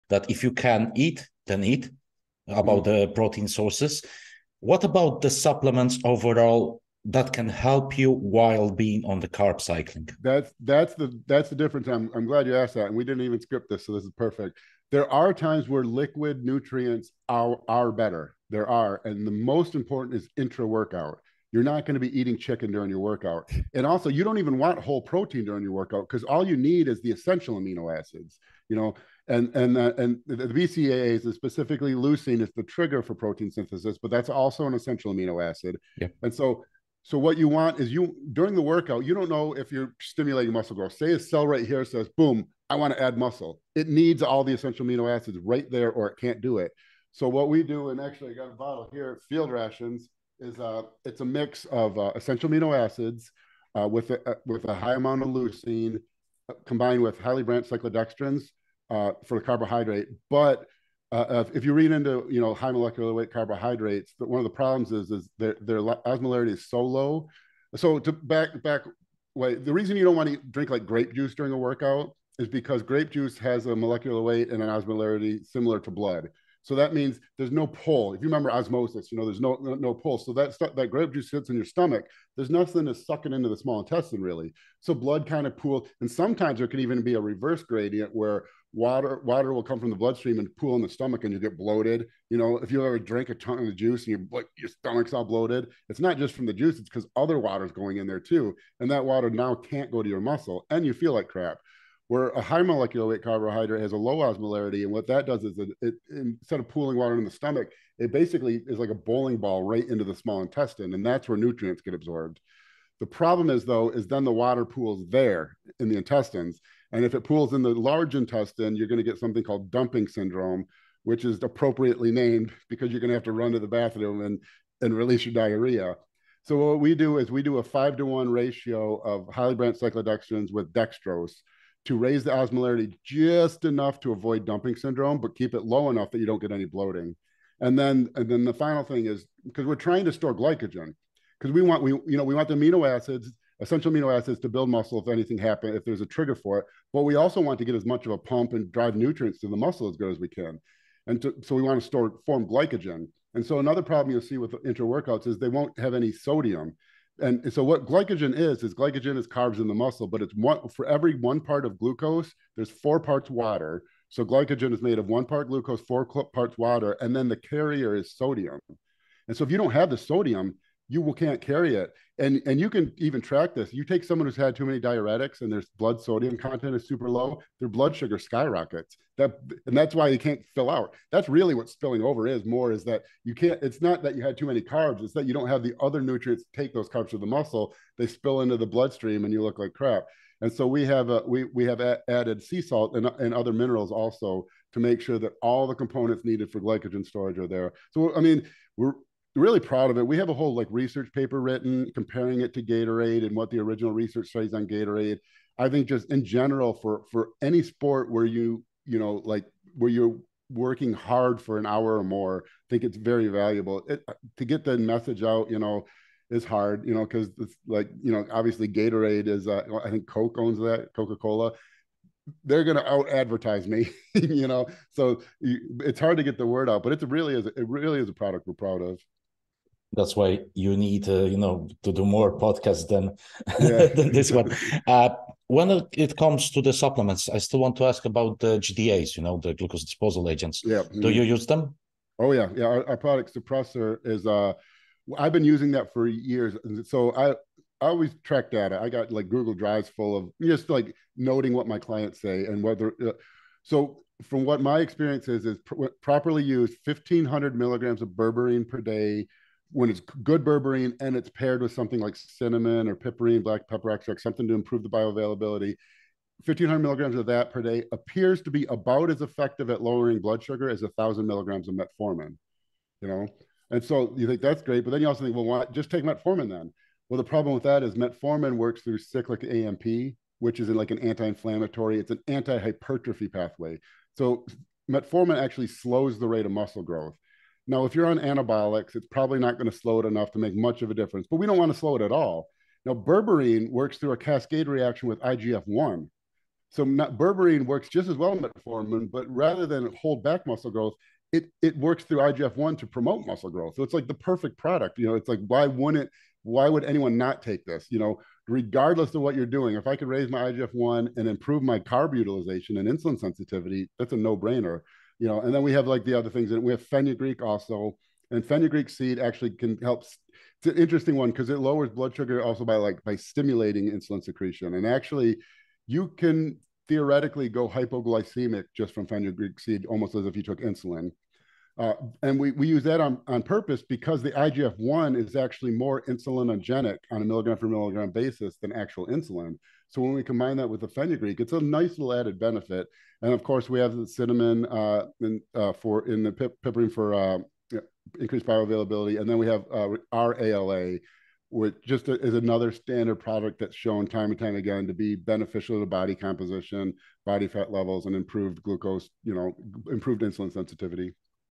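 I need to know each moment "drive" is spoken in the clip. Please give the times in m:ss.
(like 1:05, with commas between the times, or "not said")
2:28, 4:09.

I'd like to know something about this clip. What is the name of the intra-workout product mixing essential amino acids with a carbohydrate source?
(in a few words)
Field Rations.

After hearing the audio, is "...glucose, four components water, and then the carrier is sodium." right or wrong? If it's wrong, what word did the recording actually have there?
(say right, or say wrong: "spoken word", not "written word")
wrong: "parts", not "components".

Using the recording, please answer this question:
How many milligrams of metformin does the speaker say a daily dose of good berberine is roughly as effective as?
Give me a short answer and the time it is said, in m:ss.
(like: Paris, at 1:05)
1000 milligrams, at 4:30.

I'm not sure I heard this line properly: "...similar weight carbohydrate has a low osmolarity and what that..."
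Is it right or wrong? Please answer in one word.
wrong.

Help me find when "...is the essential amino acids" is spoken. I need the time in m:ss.
0:26.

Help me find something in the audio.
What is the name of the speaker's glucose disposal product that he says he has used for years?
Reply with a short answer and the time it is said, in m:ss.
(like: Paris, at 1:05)
Suppressor, at 4:03.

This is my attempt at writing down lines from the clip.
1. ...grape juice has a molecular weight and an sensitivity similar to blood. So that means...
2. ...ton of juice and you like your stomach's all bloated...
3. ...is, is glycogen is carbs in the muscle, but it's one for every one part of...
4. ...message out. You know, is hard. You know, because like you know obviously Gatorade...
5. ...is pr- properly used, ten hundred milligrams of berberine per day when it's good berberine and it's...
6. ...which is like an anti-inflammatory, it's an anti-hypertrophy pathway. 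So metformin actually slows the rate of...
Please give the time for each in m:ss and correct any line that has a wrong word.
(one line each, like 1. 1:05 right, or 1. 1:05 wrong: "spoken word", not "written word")
1. 1:12 wrong: "osmolarity", not "sensitivity"
2. 1:33 right
3. 2:38 right
4. 3:34 right
5. 4:15 wrong: "fifteen", not "ten"
6. 4:40 right.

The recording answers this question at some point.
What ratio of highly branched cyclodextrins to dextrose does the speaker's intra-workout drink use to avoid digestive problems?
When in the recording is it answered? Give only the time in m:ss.
2:07.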